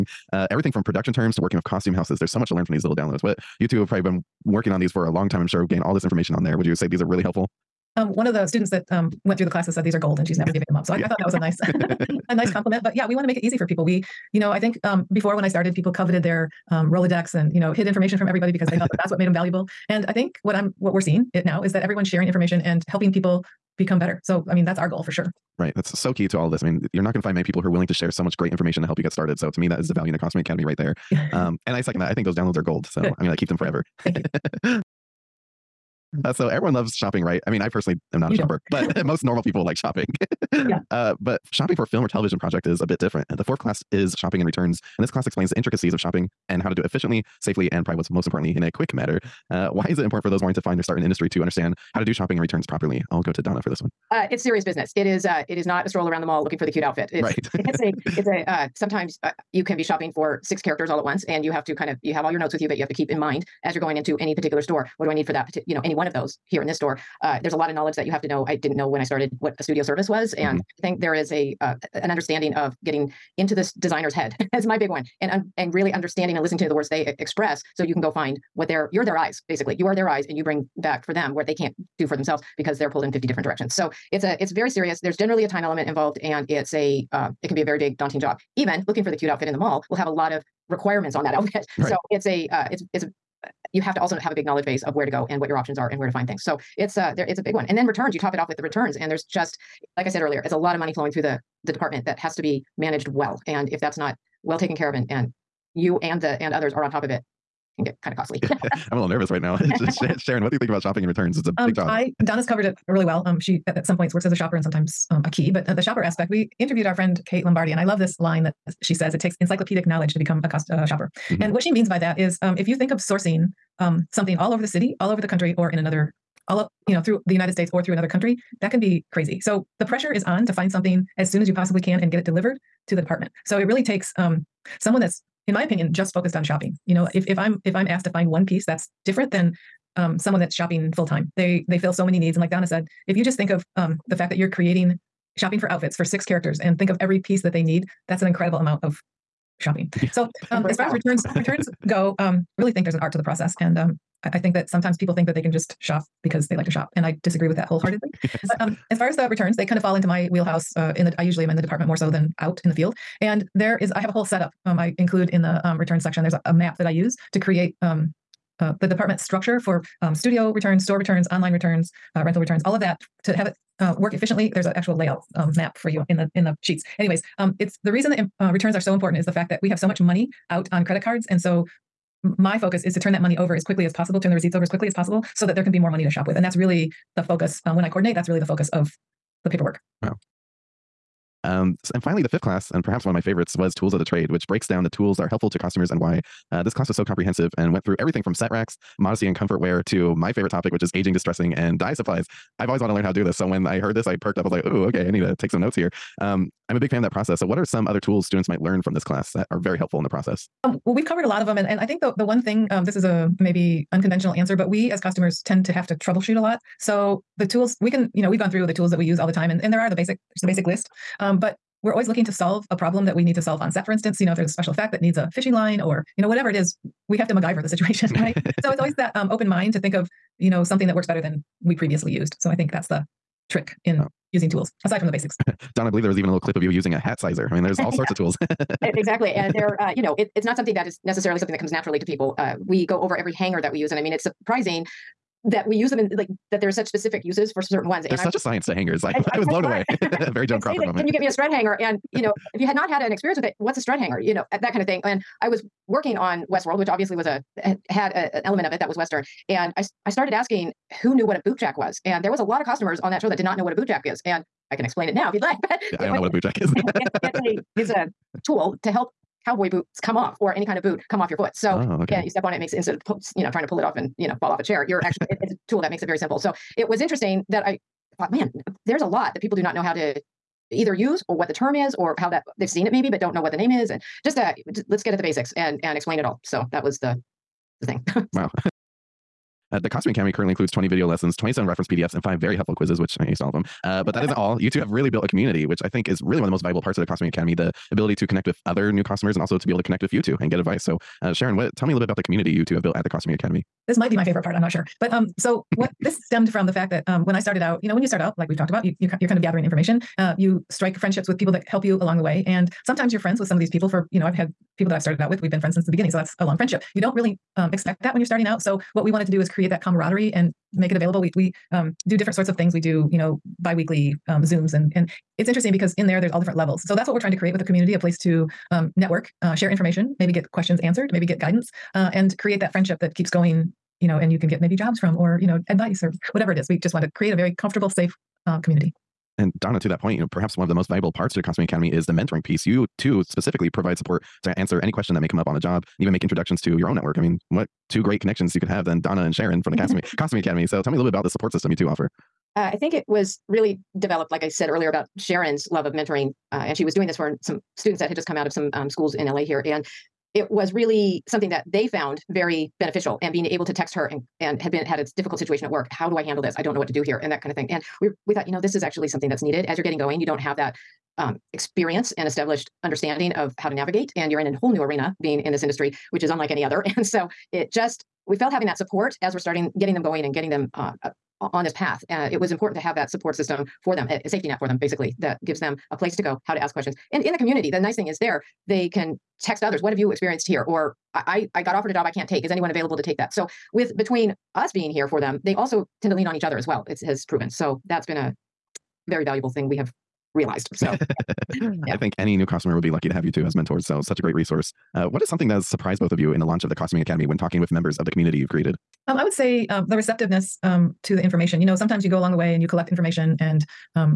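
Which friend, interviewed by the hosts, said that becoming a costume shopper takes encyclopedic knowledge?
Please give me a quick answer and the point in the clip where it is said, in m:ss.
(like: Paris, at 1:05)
Kate Lombardi, at 1:57.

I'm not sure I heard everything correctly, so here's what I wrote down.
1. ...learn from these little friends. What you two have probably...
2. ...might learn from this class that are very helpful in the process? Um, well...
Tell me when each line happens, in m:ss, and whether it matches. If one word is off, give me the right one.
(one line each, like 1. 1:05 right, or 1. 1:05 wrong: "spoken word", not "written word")
1. 0:02 wrong: "downloads", not "friends"
2. 3:28 right.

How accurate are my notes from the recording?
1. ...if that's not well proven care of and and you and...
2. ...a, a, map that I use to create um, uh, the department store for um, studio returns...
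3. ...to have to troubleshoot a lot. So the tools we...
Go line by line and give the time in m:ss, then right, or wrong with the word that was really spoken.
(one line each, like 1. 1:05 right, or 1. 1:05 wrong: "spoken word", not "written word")
1. 1:43 wrong: "taken", not "proven"
2. 2:46 wrong: "structure", not "store"
3. 3:35 right.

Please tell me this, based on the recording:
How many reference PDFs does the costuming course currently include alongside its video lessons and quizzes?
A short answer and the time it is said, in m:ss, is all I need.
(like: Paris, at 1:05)
27, at 4:51.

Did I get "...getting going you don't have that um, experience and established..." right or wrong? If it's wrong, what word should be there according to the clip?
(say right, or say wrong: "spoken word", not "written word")
right.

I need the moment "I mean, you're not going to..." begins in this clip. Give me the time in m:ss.
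0:26.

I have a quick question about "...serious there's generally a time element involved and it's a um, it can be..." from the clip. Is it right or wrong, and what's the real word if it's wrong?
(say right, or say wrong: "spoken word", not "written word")
right.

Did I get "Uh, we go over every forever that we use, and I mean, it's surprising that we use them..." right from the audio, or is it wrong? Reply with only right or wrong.
wrong.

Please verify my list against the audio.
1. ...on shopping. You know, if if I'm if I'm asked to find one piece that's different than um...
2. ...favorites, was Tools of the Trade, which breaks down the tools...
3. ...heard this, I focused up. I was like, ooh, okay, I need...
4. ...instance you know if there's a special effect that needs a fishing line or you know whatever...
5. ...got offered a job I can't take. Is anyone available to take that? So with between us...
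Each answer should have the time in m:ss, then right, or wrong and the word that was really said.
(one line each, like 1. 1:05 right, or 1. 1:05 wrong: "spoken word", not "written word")
1. 2:16 right
2. 3:13 right
3. 3:23 wrong: "perked", not "focused"
4. 3:43 right
5. 6:31 right.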